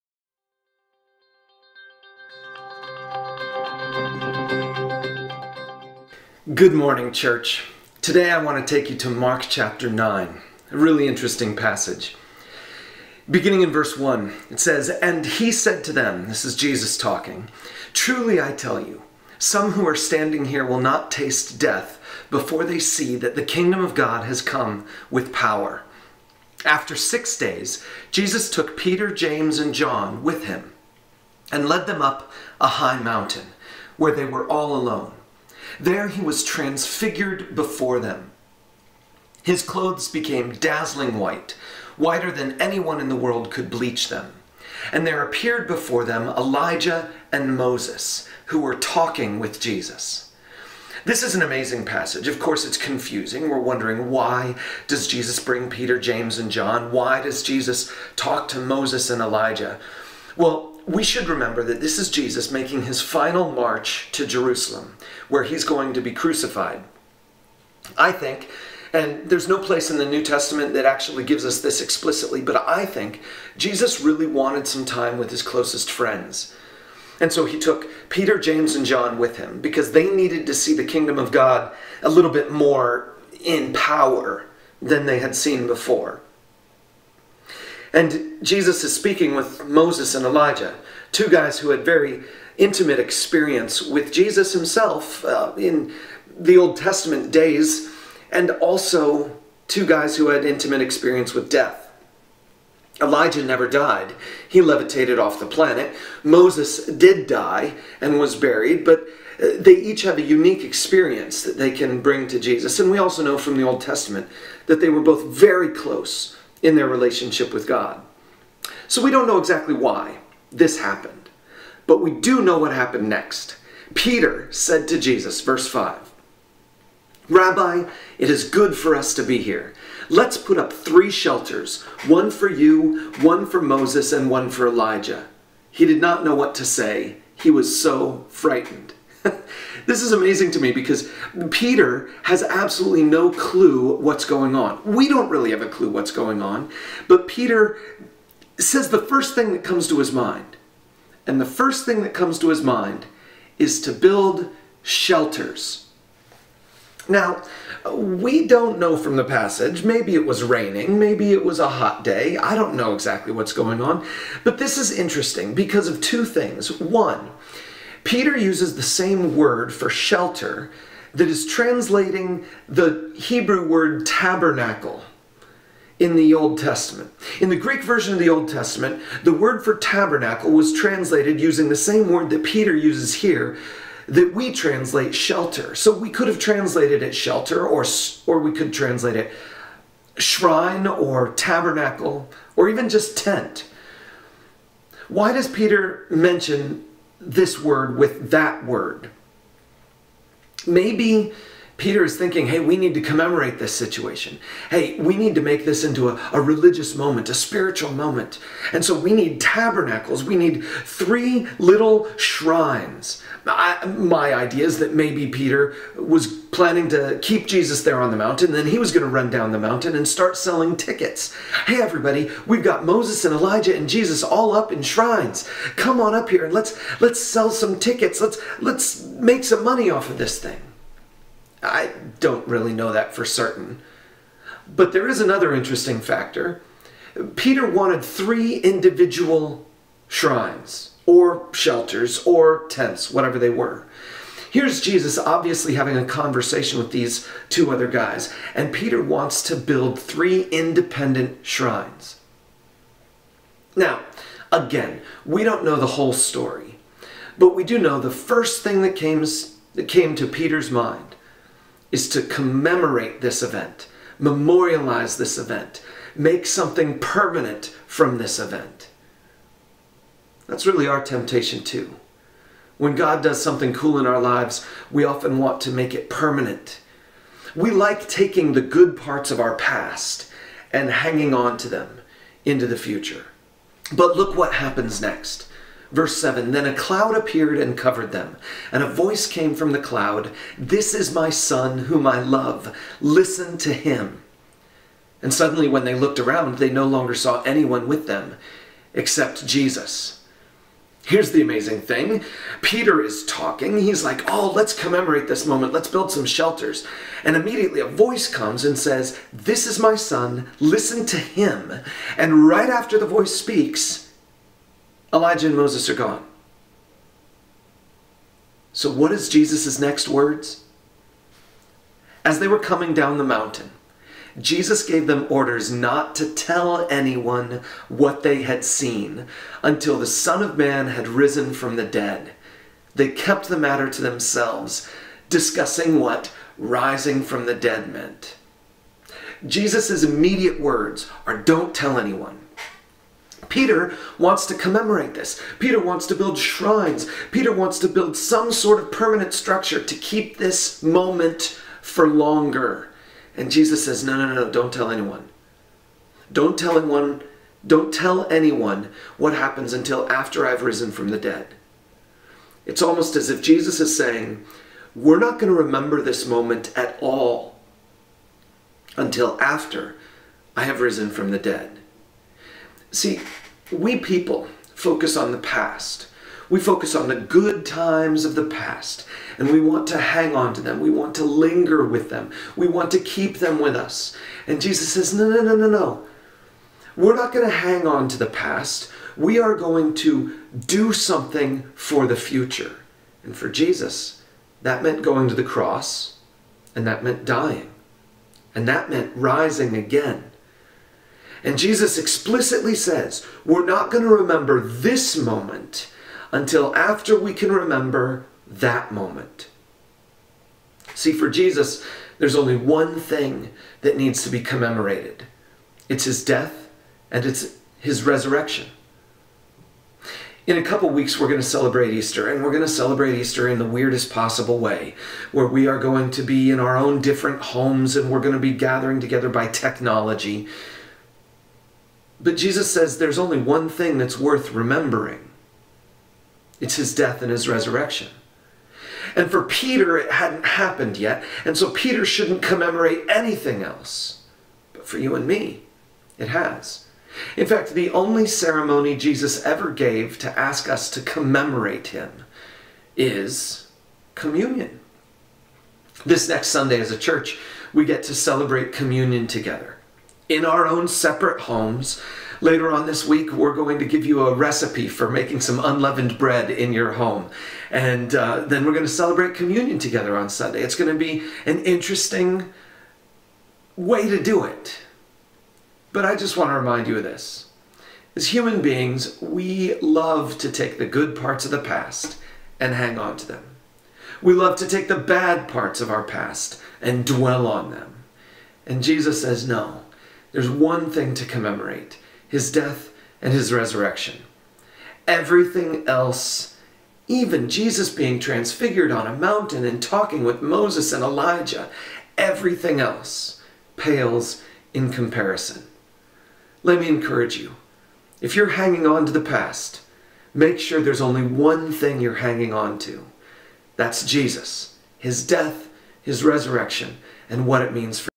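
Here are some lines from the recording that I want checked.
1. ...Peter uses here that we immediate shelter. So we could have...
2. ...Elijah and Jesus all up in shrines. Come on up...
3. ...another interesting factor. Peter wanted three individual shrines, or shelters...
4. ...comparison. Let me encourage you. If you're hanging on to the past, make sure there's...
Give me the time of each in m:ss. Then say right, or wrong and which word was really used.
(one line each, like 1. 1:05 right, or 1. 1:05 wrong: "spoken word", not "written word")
1. 3:02 wrong: "translate", not "immediate"
2. 3:43 right
3. 3:55 right
4. 8:24 right.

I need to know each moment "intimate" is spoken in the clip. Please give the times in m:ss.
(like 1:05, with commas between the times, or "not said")
1:32, 1:40.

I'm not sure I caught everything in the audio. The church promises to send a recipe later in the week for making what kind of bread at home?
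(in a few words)
Unleavened bread.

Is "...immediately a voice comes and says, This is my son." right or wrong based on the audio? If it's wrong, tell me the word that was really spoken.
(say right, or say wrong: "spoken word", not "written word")
right.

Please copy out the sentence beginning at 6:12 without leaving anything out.
See, we people focus on the past.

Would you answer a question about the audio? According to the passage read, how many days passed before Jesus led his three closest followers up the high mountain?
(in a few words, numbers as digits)
6.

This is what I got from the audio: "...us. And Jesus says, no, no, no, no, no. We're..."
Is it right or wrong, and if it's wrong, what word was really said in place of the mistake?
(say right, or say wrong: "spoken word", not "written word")
right.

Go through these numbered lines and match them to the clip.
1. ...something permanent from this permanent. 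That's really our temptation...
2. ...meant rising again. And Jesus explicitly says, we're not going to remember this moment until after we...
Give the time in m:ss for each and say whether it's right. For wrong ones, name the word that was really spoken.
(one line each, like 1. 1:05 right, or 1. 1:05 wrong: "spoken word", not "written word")
1. 4:26 wrong: "event", not "permanent"
2. 6:38 right.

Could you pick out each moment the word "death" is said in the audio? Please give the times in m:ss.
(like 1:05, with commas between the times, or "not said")
0:21, 1:41, 6:56, 7:16, 8:12, 8:35.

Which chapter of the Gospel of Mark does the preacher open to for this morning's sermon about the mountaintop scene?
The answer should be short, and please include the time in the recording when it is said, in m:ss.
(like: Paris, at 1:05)
Chapter 9, at 0:09.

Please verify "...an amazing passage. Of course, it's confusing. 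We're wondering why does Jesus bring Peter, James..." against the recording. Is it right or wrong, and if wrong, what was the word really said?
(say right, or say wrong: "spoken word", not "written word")
right.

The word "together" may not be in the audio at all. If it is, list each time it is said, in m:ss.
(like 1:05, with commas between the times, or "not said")
7:09, 7:39, 7:49.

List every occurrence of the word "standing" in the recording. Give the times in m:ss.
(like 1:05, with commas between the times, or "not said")
0:19.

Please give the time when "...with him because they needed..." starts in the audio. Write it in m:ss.
1:19.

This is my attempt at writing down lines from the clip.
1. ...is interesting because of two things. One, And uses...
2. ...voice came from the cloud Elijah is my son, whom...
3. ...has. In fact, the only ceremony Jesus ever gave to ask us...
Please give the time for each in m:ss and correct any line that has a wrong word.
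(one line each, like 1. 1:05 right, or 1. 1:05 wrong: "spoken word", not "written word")
1. 2:44 wrong: "Peter", not "And"
2. 4:48 wrong: "This", not "Elijah"
3. 7:26 right.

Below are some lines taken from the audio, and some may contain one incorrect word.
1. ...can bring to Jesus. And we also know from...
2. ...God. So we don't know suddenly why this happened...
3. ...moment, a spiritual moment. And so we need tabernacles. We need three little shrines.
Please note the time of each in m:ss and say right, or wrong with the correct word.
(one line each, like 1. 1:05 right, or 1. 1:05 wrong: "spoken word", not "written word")
1. 1:51 right
2. 1:57 wrong: "exactly", not "suddenly"
3. 3:26 right.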